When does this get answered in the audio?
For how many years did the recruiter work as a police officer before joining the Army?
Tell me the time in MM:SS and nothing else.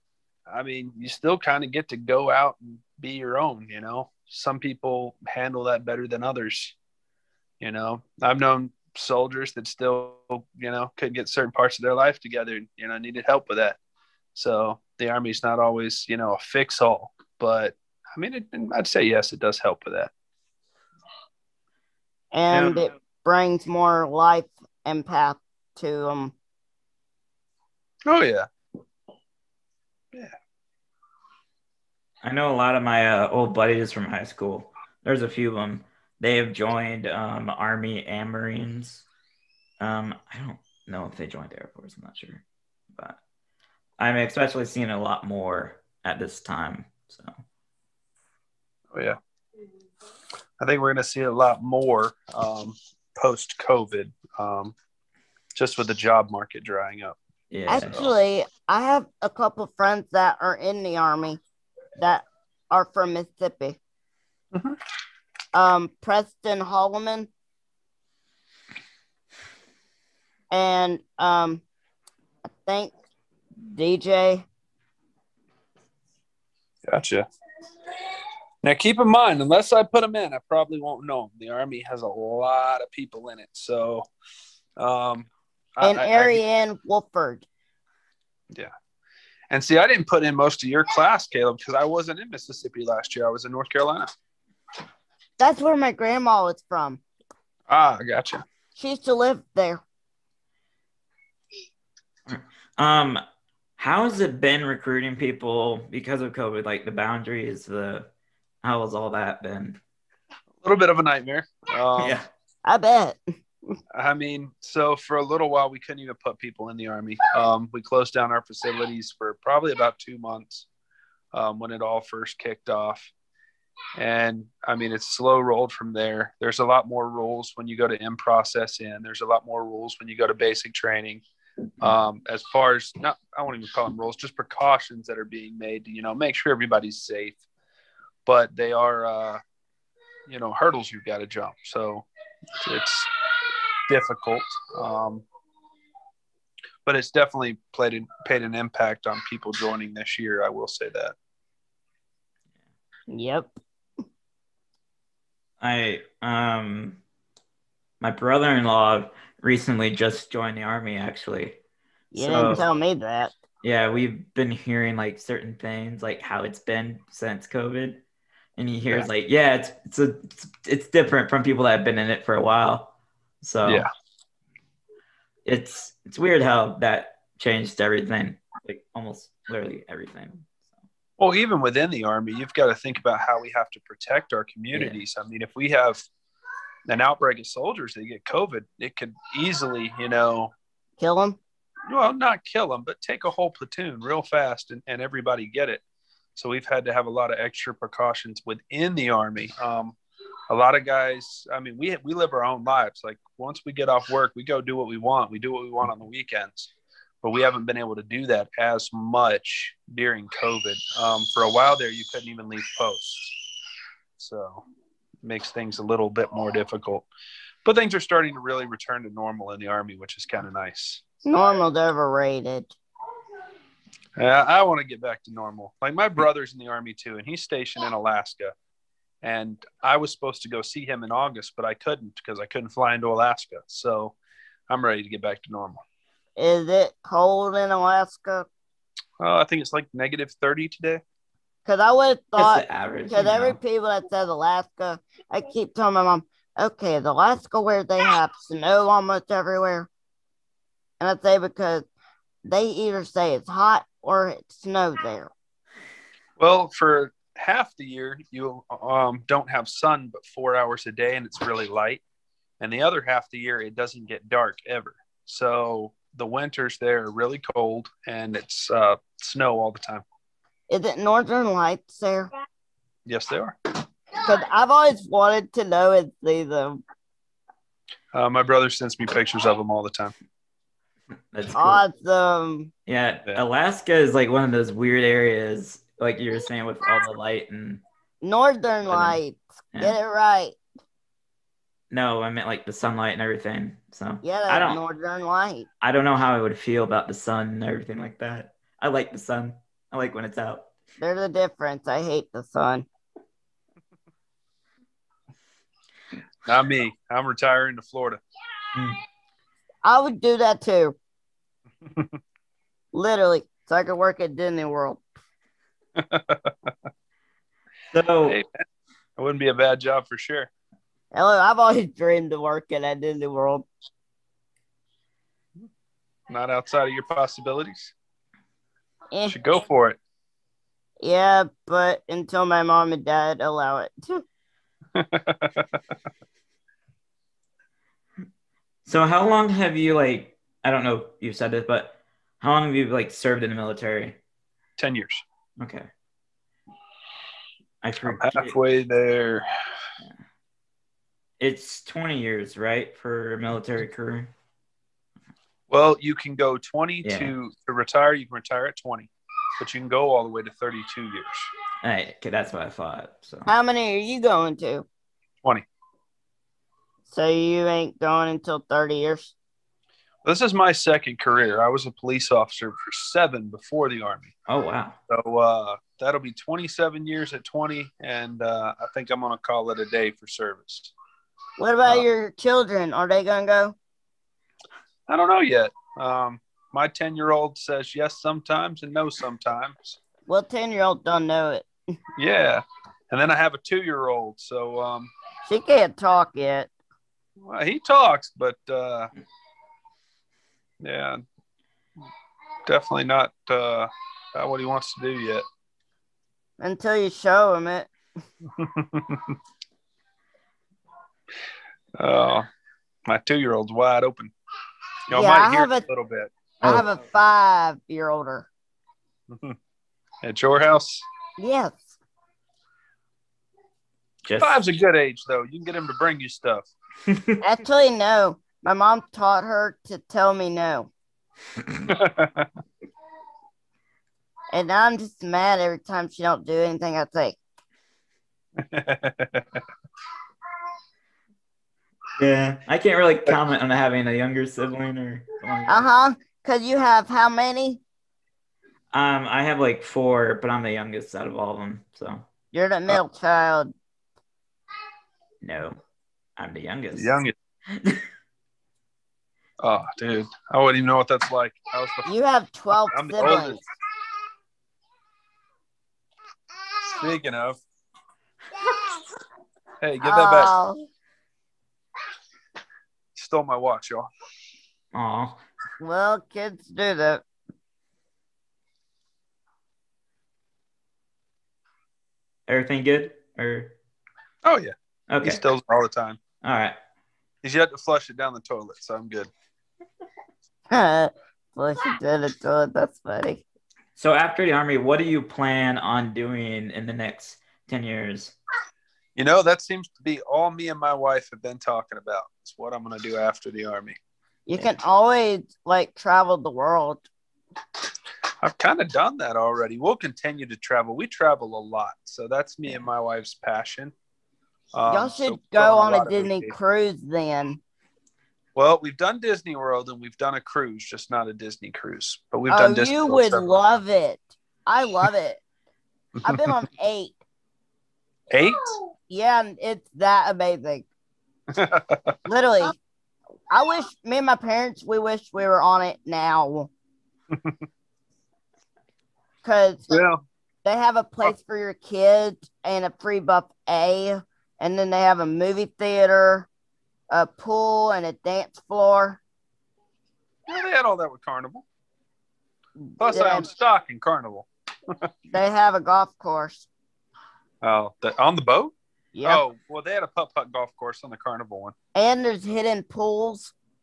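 06:13.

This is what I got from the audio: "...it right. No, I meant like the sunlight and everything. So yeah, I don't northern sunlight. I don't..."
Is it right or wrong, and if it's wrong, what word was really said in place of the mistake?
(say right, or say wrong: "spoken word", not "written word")
wrong: "light", not "sunlight".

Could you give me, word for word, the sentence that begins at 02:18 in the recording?
But they are, uh, you know, hurdles you've got to jump.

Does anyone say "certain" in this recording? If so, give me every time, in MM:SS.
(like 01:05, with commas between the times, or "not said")
00:11, 02:45.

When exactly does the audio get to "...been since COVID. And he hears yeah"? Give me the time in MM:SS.
02:46.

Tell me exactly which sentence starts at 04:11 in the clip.
And I say because they either say it's hot or it snows there.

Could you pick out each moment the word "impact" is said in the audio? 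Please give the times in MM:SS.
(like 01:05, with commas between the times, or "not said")
02:28.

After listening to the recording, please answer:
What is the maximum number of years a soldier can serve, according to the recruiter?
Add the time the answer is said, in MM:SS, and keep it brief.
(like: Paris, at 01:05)
32, at 06:00.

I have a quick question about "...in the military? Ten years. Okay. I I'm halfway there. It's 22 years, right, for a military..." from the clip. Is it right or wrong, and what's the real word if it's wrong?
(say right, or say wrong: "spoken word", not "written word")
wrong: "20", not "22".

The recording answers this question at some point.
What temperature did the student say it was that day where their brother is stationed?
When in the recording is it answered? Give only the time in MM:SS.
03:59.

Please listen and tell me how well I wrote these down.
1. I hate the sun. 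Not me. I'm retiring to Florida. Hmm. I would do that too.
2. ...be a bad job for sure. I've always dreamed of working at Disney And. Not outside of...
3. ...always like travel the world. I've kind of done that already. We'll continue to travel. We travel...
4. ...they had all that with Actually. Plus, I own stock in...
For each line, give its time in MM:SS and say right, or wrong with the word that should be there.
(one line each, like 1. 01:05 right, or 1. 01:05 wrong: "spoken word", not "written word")
1. 05:01 right
2. 05:19 wrong: "World", not "And"
3. 08:24 right
4. 09:10 wrong: "Carnival", not "Actually".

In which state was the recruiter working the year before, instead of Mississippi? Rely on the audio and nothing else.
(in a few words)
North Carolina.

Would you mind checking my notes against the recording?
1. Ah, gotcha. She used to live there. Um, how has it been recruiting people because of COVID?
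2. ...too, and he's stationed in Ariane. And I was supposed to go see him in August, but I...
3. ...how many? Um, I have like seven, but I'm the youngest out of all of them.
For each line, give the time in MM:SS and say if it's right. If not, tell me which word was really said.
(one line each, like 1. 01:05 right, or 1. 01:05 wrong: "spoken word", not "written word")
1. 01:37 right
2. 03:46 wrong: "Alaska", not "Ariane"
3. 07:27 wrong: "four", not "seven".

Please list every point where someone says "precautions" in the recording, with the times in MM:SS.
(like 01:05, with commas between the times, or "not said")
02:14, 03:17.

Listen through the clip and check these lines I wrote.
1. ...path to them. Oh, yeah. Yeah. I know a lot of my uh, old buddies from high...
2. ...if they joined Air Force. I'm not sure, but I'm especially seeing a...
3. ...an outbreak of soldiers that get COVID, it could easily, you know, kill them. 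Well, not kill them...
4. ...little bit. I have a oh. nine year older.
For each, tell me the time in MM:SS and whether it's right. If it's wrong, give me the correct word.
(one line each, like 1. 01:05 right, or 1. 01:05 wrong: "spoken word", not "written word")
1. 00:25 right
2. 00:41 right
3. 03:06 right
4. 06:55 wrong: "five", not "nine".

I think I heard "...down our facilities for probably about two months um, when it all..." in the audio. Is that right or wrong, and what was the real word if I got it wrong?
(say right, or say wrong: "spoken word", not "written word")
right.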